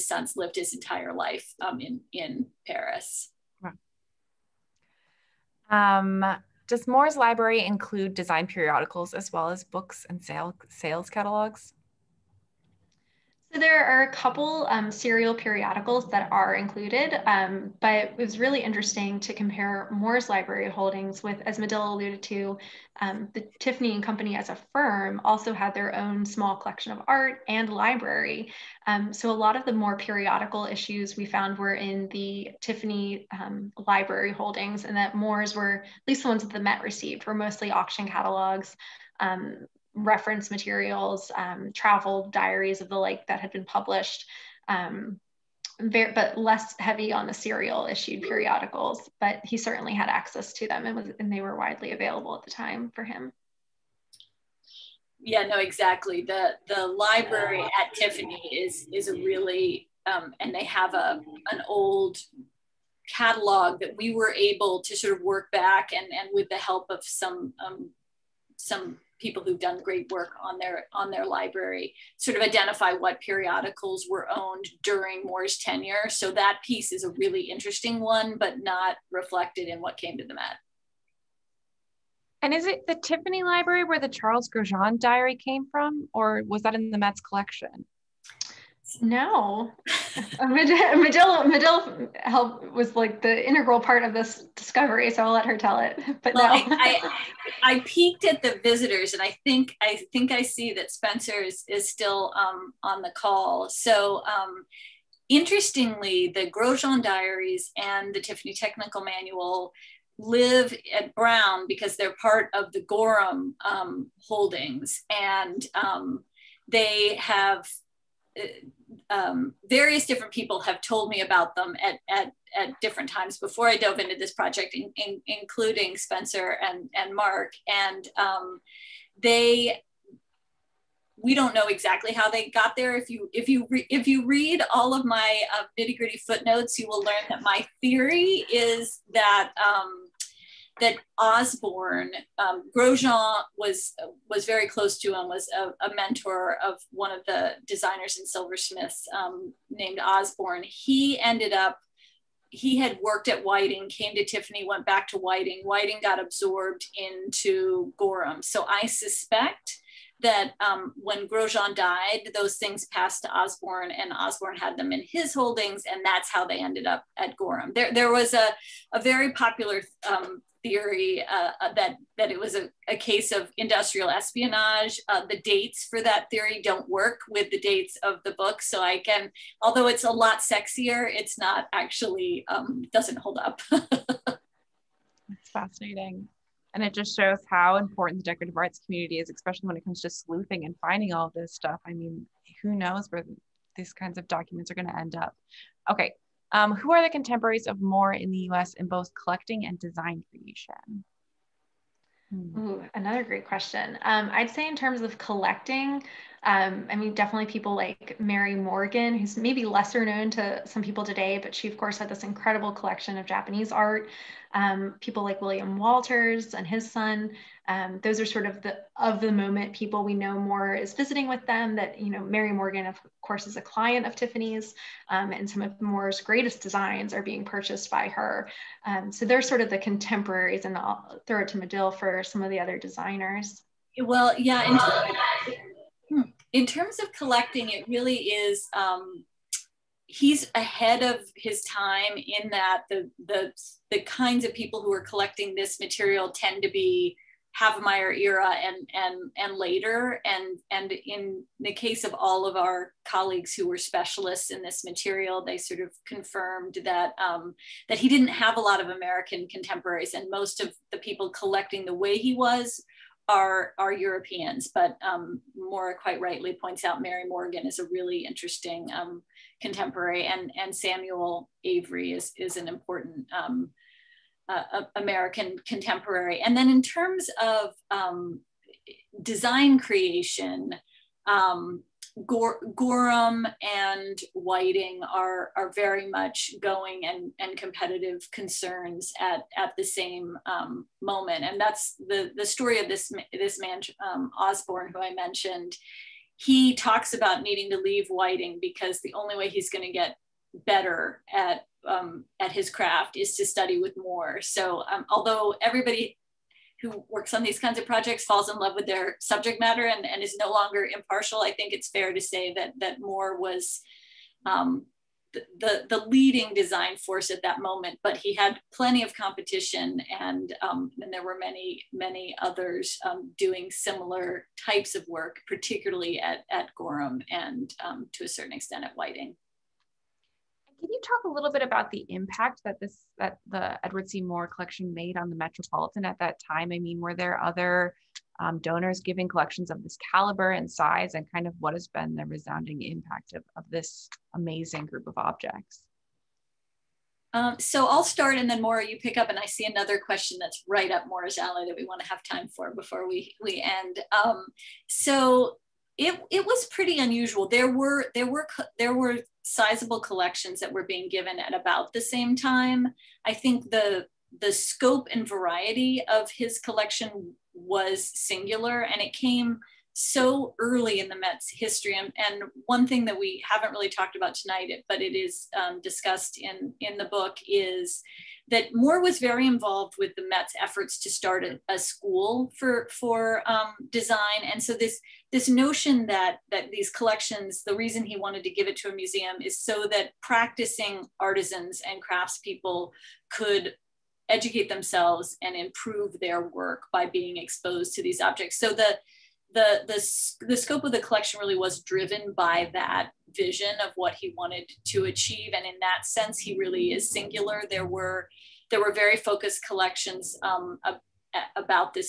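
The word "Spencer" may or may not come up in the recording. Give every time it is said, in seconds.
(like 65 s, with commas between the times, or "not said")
100 s, 125 s.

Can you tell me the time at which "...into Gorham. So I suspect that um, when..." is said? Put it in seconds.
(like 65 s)
156 s.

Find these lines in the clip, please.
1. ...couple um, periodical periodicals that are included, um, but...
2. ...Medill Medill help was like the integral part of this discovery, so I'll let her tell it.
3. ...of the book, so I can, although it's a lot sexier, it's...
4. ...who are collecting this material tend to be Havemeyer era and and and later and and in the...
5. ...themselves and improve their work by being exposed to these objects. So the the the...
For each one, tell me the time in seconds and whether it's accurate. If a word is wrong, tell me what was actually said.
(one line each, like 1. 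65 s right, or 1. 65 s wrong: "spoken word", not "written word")
1. 14 s wrong: "serial", not "periodical"
2. 90 s right
3. 178 s right
4. 244 s right
5. 394 s right.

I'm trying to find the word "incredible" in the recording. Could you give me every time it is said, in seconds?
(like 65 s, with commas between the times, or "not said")
212 s.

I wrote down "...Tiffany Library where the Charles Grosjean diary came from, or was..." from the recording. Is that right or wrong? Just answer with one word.
right.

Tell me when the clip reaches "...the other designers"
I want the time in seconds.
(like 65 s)
232 s.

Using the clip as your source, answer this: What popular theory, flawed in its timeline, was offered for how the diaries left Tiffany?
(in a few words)
Industrial espionage.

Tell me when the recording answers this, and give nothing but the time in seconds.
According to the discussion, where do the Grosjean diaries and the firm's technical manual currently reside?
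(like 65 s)
111 s.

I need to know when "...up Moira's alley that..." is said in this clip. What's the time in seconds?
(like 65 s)
350 s.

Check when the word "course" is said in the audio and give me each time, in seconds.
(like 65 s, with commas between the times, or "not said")
211 s, 223 s.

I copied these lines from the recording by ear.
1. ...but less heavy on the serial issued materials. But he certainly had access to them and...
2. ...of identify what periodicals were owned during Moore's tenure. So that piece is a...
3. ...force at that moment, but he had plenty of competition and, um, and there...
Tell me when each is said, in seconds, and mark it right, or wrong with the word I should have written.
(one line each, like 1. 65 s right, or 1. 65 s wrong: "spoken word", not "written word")
1. 46 s wrong: "periodicals", not "materials"
2. 72 s right
3. 316 s right.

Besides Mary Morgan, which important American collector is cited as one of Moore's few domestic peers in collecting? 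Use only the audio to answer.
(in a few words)
Samuel Avery.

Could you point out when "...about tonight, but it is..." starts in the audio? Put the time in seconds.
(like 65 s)
374 s.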